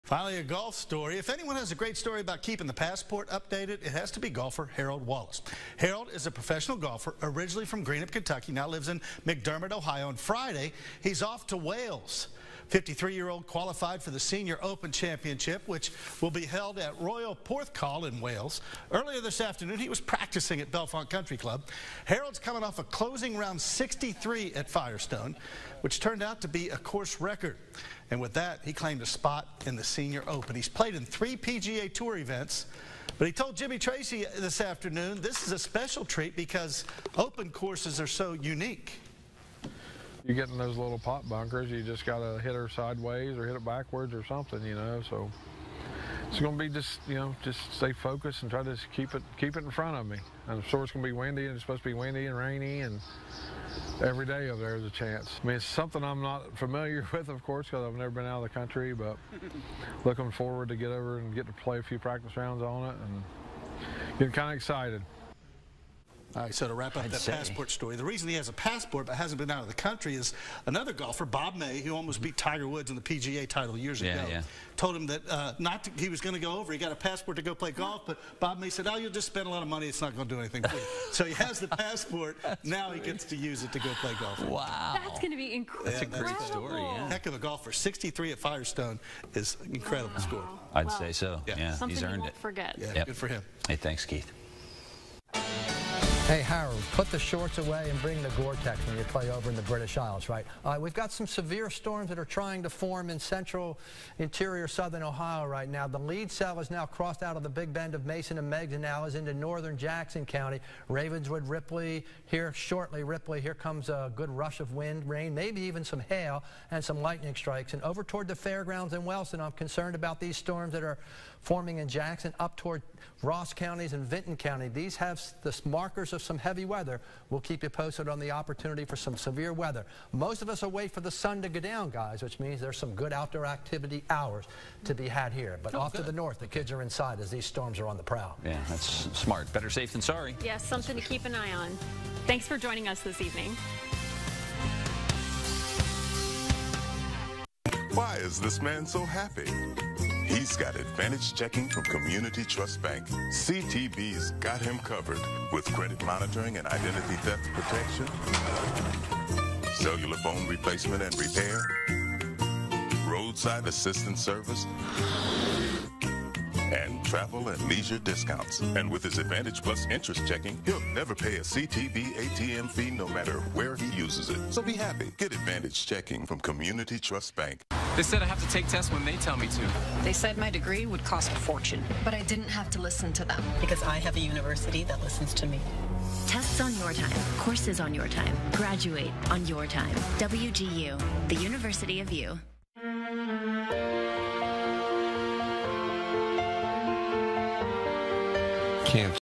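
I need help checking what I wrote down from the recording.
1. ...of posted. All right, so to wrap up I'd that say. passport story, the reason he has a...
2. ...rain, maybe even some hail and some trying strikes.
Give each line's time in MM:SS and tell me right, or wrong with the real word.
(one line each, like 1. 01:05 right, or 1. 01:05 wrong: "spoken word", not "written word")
1. 01:04 wrong: "excited", not "posted"
2. 01:55 wrong: "lightning", not "trying".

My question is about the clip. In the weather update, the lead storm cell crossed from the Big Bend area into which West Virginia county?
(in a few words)
Jackson County.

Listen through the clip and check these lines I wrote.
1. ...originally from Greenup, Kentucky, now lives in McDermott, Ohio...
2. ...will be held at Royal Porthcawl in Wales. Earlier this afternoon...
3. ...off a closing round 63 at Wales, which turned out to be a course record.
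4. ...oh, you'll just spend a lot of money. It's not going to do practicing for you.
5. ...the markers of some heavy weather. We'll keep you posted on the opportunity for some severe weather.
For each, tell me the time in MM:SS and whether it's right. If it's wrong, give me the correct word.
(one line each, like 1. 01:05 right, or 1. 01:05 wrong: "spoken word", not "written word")
1. 00:07 right
2. 00:16 right
3. 00:22 wrong: "Firestone", not "Wales"
4. 01:18 wrong: "anything", not "practicing"
5. 02:05 right.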